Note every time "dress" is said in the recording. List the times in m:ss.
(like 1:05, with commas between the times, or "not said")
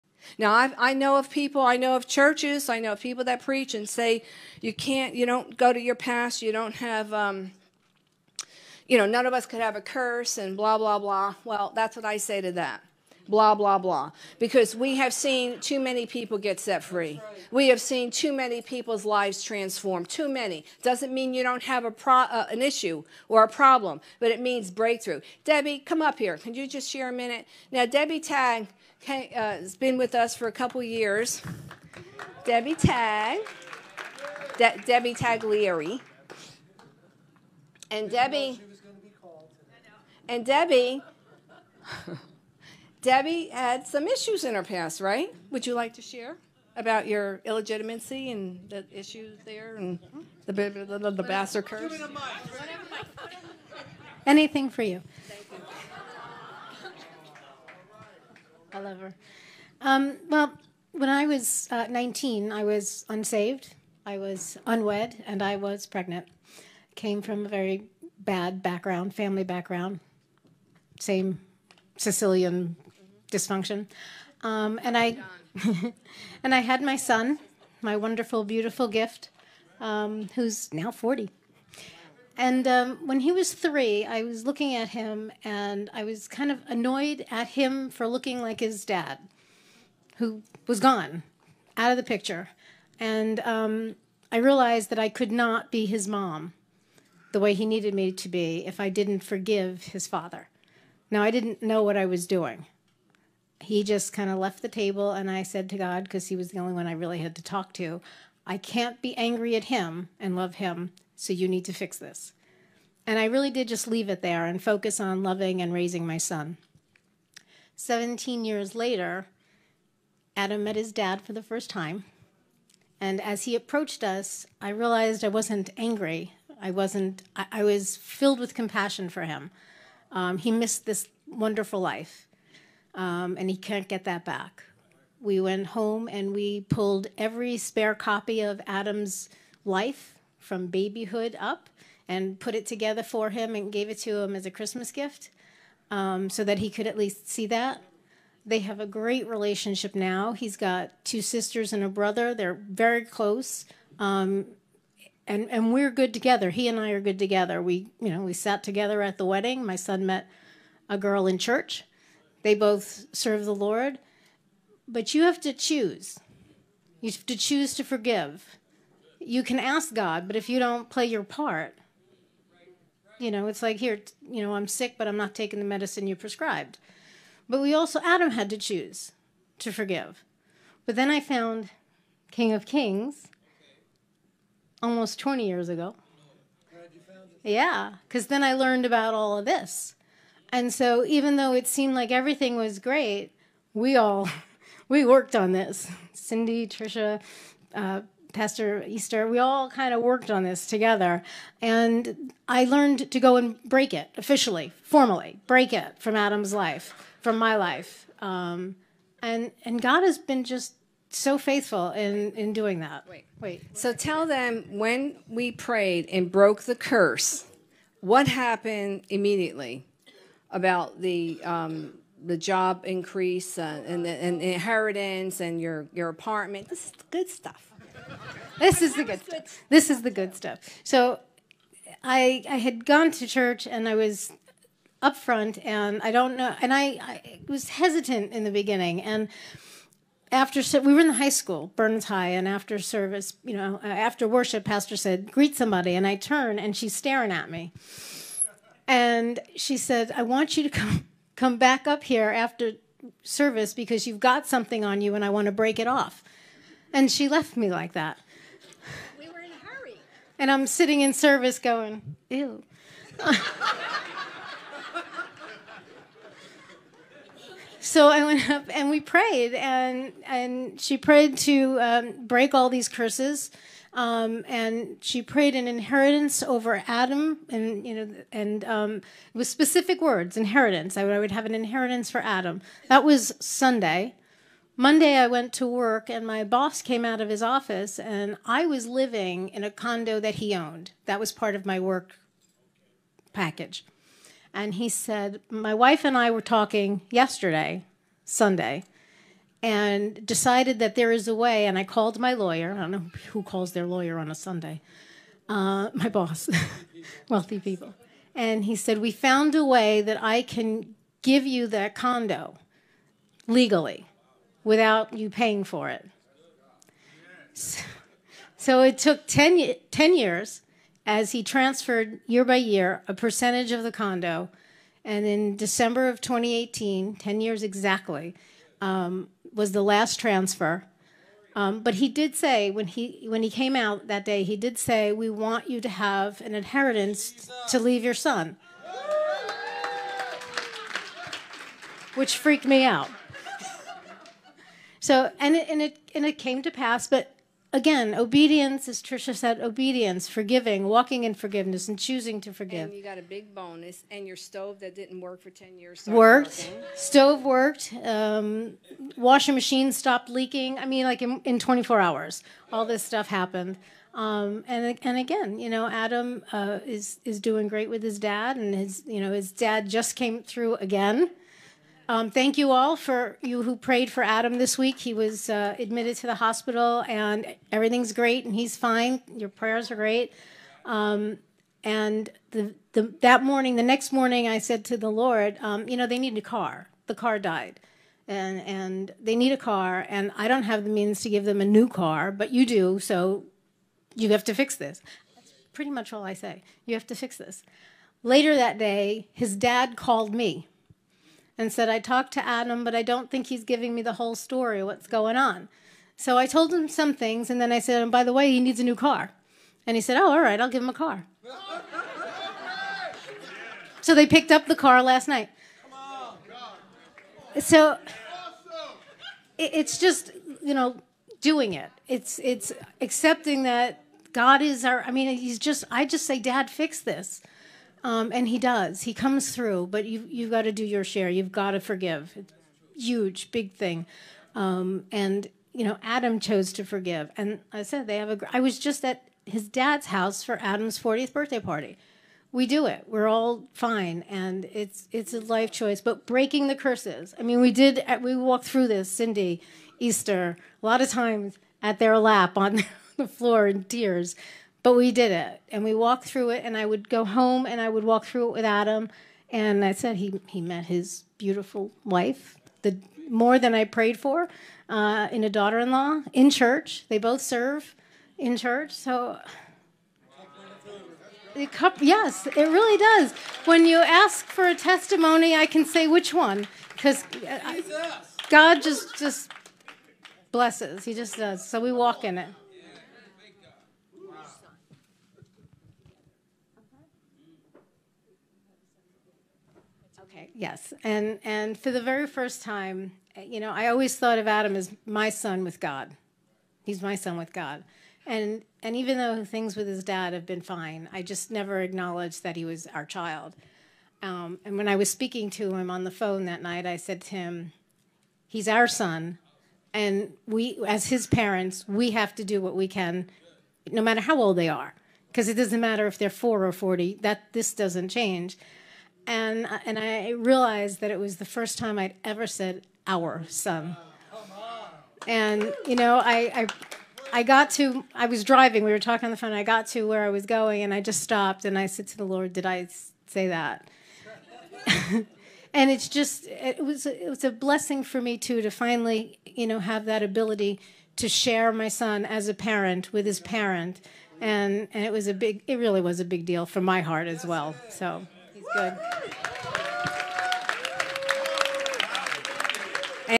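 not said.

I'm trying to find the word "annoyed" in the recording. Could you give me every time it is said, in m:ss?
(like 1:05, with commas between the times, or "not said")
1:26.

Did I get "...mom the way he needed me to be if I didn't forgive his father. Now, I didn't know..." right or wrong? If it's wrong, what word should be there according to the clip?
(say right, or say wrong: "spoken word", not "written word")
right.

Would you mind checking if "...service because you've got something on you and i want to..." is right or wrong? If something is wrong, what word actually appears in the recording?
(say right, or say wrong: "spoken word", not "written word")
right.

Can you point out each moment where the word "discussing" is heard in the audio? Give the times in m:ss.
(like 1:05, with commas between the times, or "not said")
not said.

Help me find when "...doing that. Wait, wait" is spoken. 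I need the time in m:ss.
3:32.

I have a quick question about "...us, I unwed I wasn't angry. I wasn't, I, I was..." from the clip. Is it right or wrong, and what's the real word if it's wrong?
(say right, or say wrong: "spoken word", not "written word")
wrong: "realized", not "unwed".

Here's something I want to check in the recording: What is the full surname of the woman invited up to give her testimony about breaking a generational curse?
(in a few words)
Taglieri.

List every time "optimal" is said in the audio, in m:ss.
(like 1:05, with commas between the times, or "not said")
not said.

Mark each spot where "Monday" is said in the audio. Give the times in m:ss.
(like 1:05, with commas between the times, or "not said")
4:44.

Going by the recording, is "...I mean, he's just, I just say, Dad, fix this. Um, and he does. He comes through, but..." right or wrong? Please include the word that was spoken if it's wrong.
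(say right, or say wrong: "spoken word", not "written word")
right.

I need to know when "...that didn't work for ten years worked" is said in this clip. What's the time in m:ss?
5:54.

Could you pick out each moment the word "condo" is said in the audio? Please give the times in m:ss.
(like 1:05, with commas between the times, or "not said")
4:49, 5:11, 5:23.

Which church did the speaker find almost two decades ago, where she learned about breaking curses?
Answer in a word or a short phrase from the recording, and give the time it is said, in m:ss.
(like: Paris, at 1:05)
King of Kings, at 3:02.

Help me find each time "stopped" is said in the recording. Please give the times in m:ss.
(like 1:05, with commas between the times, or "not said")
5:59, 8:51.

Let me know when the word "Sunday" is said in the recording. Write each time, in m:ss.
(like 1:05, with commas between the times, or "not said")
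4:43, 4:58, 5:04.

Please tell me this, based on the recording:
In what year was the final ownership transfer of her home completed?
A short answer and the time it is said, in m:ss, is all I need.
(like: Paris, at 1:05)
2018, at 5:26.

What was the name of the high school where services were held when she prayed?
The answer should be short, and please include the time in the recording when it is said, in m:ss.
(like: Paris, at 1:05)
Burns High, at 4:01.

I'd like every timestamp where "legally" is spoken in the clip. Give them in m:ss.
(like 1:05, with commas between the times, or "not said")
5:13.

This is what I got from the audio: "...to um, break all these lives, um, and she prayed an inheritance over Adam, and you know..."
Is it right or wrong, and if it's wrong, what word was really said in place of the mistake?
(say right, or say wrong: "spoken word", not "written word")
wrong: "curses", not "lives".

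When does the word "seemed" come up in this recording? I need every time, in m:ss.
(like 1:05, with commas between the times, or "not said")
3:11.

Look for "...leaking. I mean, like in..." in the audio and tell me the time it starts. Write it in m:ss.
6:00.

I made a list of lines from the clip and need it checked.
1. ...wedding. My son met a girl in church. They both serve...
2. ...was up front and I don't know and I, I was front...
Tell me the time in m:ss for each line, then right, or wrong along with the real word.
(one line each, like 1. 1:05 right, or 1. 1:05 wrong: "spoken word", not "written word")
1. 2:39 right
2. 3:53 wrong: "hesitant", not "front".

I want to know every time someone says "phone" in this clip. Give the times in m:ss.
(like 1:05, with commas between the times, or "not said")
8:26, 8:49.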